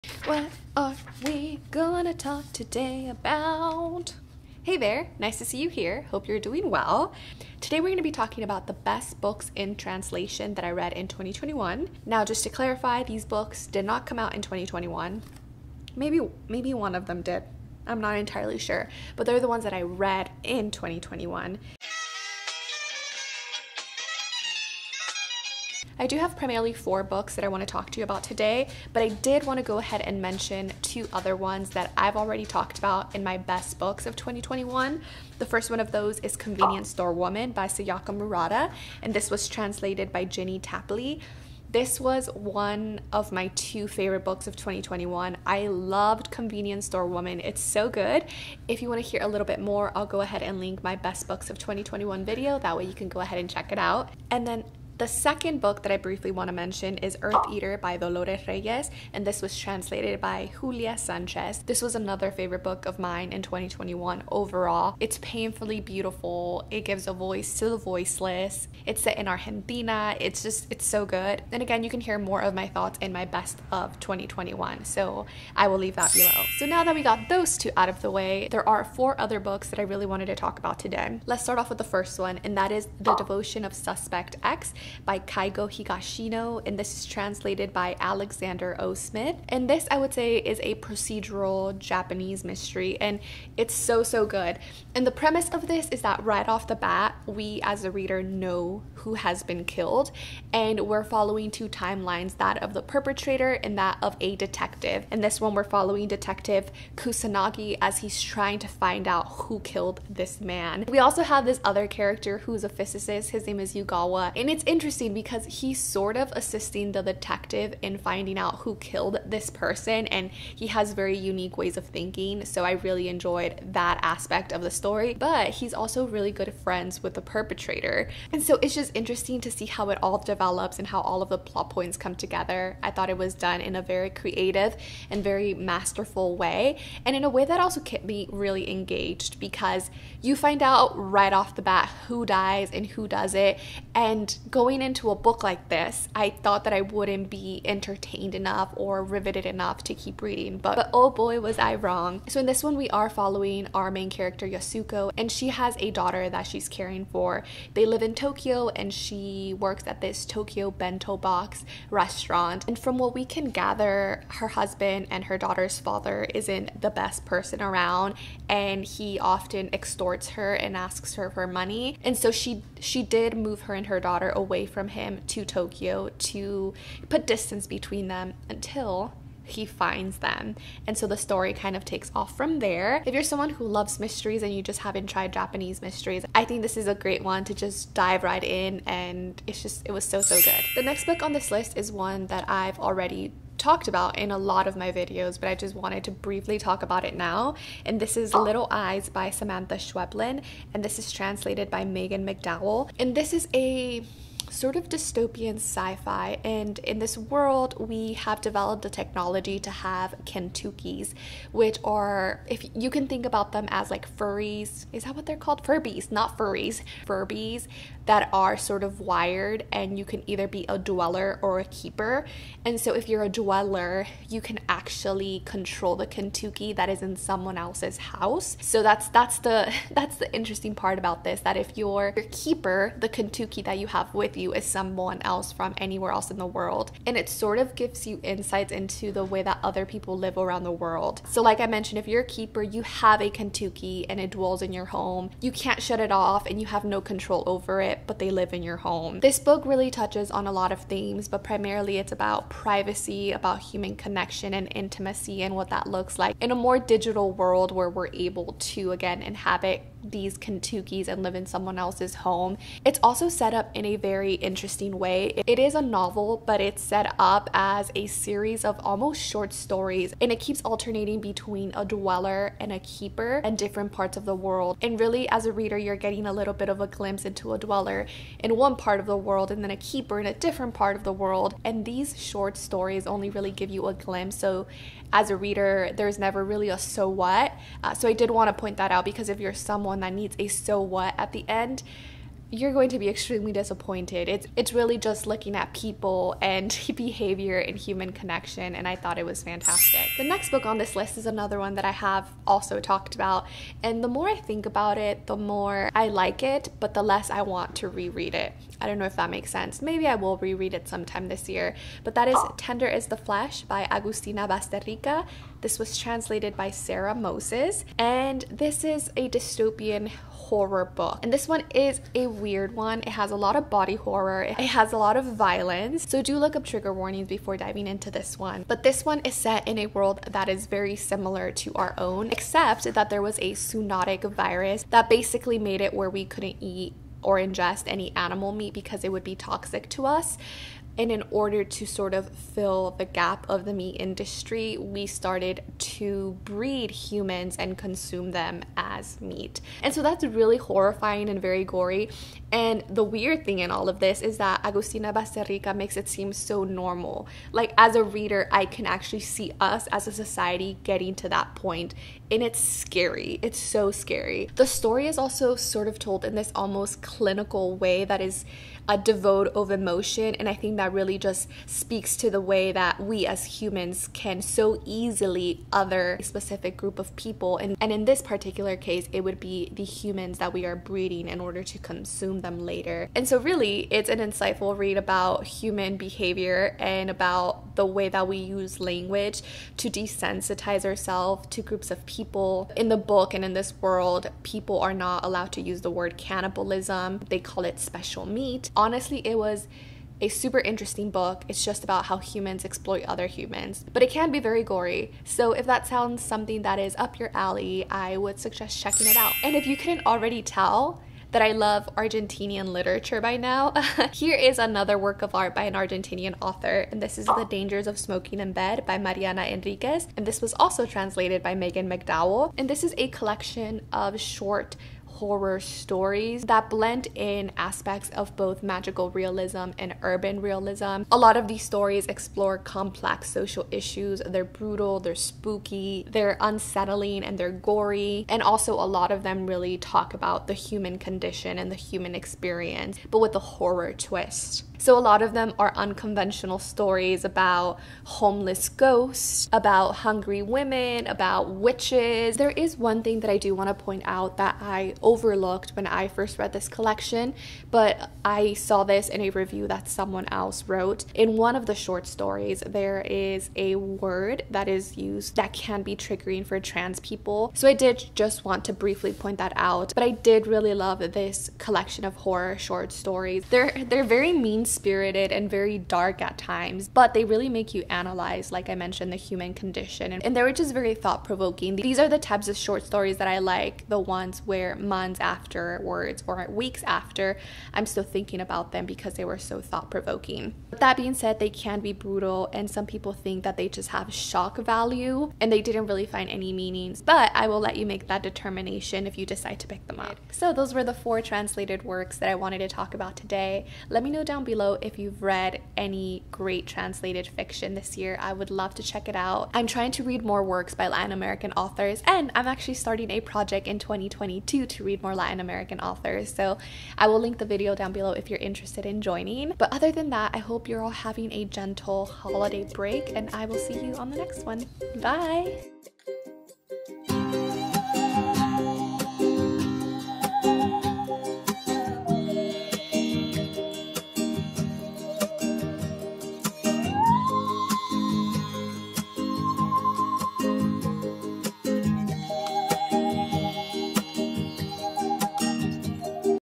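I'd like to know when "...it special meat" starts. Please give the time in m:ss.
6:37.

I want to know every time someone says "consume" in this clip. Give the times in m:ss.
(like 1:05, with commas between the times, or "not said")
5:47, 6:21.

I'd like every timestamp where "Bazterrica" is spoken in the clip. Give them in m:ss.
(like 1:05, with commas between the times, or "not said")
5:14, 5:55.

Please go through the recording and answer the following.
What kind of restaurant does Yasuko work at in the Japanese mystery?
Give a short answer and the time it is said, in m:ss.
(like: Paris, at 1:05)
Tokyo bento box restaurant, at 2:40.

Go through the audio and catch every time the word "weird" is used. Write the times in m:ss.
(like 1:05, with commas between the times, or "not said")
5:22, 5:53.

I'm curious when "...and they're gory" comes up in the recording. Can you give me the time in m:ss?
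7:17.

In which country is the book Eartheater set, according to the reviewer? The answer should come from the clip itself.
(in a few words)
Argentina.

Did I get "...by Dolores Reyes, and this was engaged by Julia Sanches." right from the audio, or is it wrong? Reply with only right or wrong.
wrong.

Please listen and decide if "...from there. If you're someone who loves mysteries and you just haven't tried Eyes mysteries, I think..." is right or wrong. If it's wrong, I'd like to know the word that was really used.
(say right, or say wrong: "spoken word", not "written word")
wrong: "Japanese", not "Eyes".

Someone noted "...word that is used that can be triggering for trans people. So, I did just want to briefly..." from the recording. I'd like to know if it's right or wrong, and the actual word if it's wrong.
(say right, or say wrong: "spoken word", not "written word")
right.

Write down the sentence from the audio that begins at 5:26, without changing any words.
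So do look up trigger warnings before diving into this one.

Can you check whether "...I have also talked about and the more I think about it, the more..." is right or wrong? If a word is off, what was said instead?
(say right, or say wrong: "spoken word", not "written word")
right.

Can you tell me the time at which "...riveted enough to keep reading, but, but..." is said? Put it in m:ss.
2:29.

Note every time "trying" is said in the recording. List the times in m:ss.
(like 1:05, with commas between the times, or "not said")
1:48, 8:29.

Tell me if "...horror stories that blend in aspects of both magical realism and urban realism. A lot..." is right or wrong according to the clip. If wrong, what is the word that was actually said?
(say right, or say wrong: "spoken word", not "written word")
right.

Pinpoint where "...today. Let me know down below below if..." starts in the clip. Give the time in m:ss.
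8:23.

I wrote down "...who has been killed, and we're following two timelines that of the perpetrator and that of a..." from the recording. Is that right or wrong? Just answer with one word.
right.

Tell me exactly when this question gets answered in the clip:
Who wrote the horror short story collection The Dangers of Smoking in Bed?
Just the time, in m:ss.
6:58.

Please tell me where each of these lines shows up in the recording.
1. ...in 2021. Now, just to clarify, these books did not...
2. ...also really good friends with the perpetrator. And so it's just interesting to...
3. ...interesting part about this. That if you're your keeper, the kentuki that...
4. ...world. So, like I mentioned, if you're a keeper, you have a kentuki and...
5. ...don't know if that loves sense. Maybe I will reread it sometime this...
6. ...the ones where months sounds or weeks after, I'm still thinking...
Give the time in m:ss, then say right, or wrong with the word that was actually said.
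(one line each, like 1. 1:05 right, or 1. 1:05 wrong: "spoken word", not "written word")
1. 0:10 right
2. 2:05 right
3. 3:50 right
4. 4:00 right
5. 5:08 wrong: "makes", not "loves"
6. 8:03 wrong: "afterwards", not "sounds".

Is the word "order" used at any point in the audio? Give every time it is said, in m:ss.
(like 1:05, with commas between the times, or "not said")
5:41, 6:21.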